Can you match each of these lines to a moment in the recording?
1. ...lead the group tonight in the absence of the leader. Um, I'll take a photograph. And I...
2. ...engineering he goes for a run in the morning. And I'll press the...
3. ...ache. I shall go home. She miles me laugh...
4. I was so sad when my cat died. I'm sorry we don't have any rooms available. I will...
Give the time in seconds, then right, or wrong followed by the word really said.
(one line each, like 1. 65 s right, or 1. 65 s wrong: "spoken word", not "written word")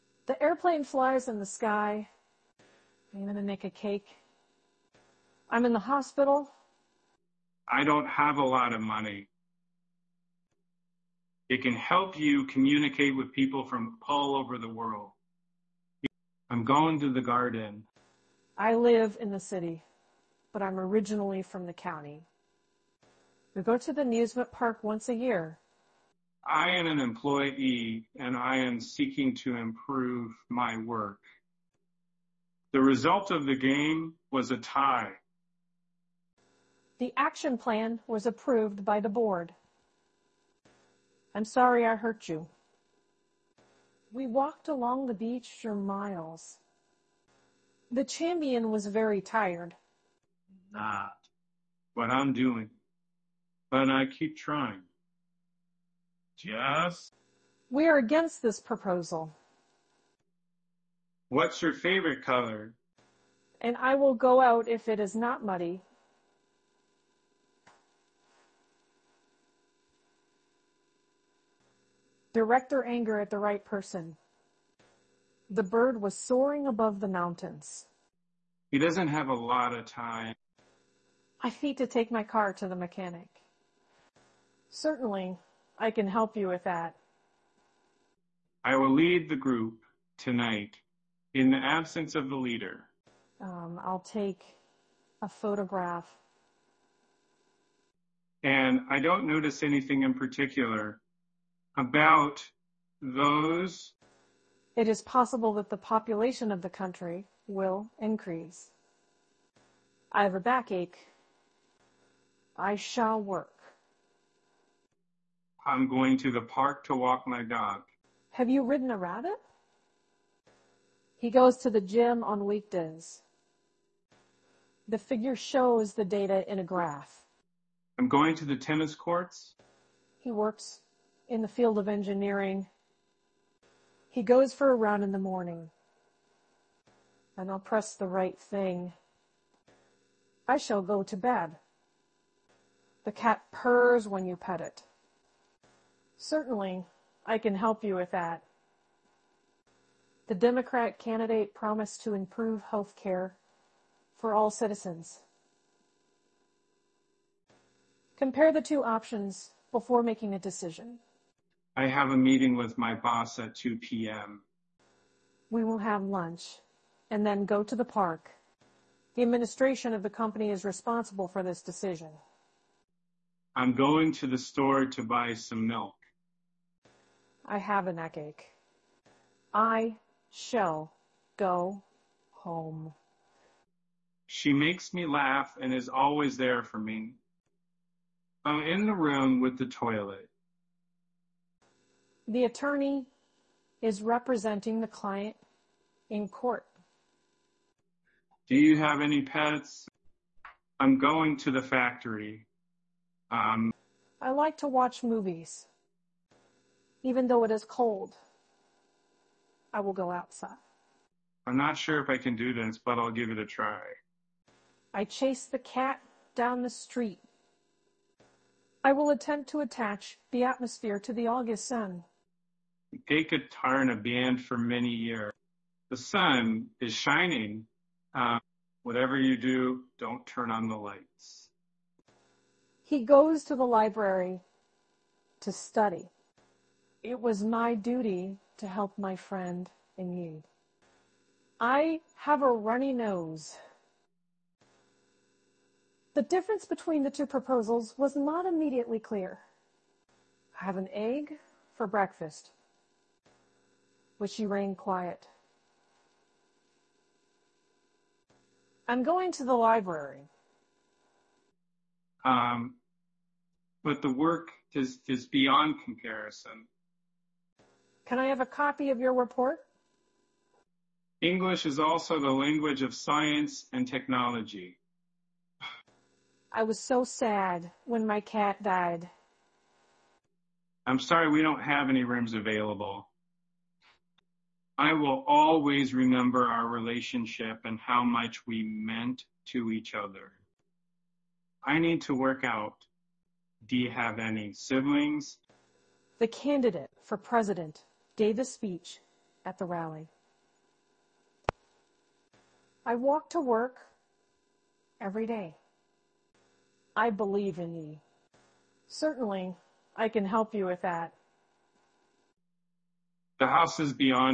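1. 88 s right
2. 131 s right
3. 178 s wrong: "makes", not "miles"
4. 276 s right.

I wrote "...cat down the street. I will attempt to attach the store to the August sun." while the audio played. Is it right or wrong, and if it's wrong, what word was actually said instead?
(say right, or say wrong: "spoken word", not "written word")
wrong: "atmosphere", not "store".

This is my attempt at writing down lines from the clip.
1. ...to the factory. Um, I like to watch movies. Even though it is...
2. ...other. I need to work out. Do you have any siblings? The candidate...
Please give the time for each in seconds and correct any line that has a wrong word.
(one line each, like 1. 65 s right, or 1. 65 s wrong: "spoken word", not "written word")
1. 201 s right
2. 289 s right.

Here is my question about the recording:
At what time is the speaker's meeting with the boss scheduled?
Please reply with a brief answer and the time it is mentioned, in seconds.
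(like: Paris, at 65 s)
2 p.m., at 163 s.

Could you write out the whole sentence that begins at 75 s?
The bird was soaring above the mountains.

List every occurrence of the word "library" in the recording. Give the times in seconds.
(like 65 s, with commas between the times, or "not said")
233 s, 259 s.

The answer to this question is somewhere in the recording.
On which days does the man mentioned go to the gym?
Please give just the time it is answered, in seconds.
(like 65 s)
122 s.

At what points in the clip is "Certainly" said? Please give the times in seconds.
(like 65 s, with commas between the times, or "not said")
84 s, 146 s, 308 s.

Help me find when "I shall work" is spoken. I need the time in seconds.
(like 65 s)
112 s.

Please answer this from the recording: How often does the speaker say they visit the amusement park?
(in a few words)
once a year.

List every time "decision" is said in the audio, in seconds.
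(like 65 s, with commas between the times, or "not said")
160 s, 171 s.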